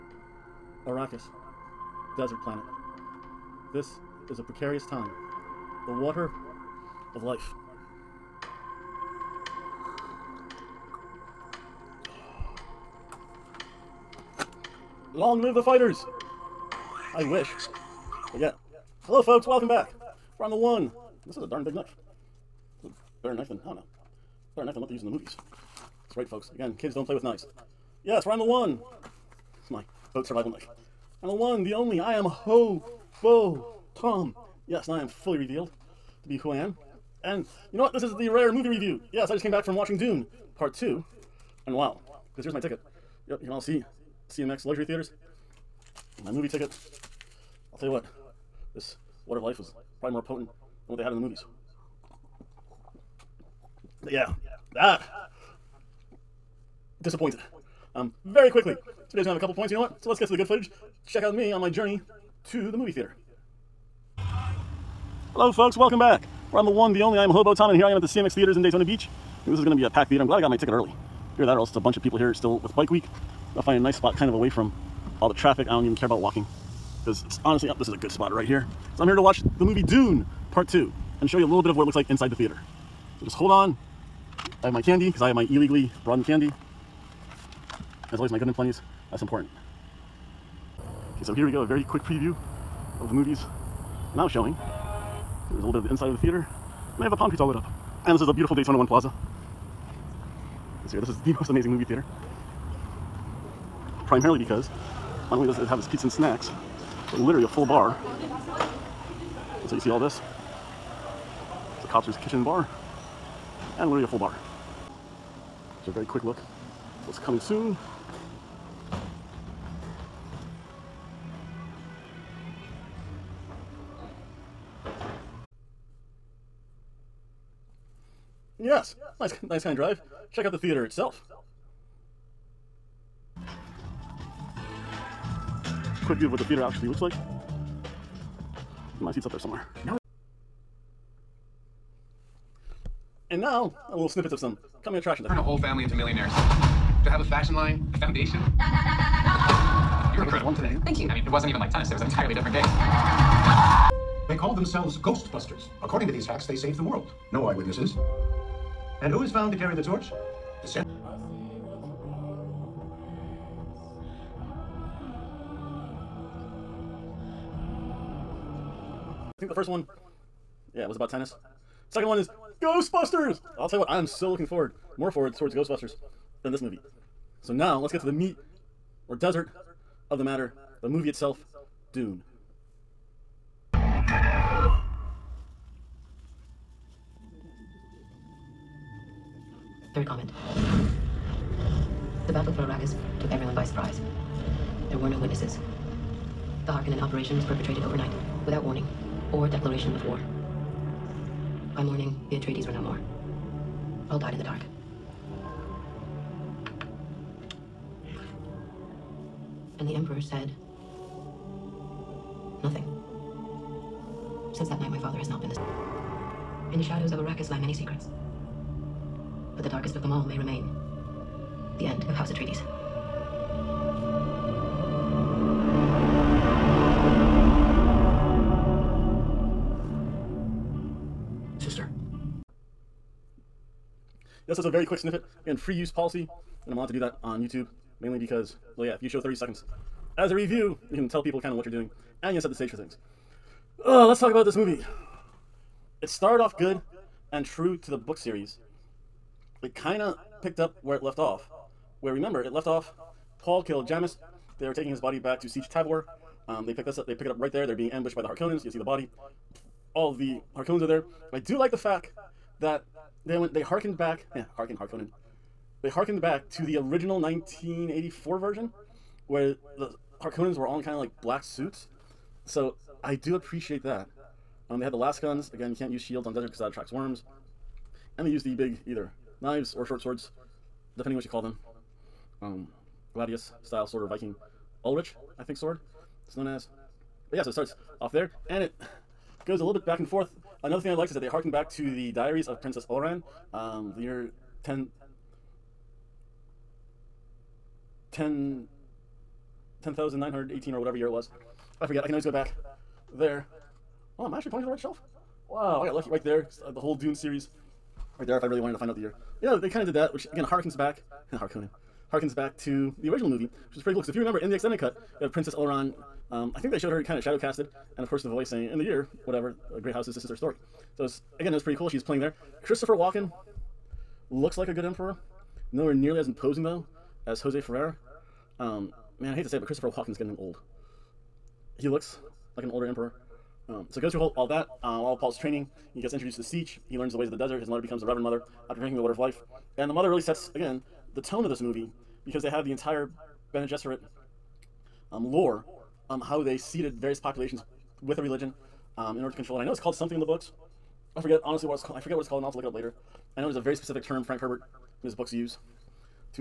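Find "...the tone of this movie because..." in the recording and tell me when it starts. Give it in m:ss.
5:41.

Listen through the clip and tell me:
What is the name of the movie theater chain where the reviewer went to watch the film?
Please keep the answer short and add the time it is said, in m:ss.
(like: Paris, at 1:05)
CMX Theaters, at 1:08.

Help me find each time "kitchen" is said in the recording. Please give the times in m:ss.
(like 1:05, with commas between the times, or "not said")
1:52.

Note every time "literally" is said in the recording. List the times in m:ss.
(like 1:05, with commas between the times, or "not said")
1:47, 1:53.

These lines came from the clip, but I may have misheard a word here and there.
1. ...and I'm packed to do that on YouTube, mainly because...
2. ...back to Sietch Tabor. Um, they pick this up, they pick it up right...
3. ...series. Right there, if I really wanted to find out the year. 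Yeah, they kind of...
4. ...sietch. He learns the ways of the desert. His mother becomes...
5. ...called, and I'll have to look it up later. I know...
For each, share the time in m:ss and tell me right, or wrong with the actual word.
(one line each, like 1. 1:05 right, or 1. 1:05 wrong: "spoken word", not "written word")
1. 3:56 wrong: "allowed", not "packed"
2. 4:15 right
3. 5:07 right
4. 5:36 right
5. 5:52 right.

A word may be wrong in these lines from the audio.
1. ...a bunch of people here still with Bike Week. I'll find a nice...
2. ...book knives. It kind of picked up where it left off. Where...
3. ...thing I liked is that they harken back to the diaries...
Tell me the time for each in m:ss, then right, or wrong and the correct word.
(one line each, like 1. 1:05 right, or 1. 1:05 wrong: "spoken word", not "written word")
1. 1:11 right
2. 4:07 wrong: "series", not "knives"
3. 4:50 right.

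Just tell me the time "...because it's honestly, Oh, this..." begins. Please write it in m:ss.
1:17.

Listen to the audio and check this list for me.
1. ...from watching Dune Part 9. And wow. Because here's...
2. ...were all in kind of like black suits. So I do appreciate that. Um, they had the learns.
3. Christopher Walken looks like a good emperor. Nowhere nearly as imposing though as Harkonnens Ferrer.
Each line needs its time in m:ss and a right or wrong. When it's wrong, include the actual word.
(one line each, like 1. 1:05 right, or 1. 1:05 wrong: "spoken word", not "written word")
1. 0:39 wrong: "2", not "9"
2. 4:30 wrong: "lasguns", not "learns"
3. 5:22 wrong: "Jose", not "Harkonnens".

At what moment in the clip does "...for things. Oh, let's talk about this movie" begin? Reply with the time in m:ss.
4:02.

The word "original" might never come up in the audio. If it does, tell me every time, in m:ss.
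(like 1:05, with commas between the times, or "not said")
4:26, 5:13.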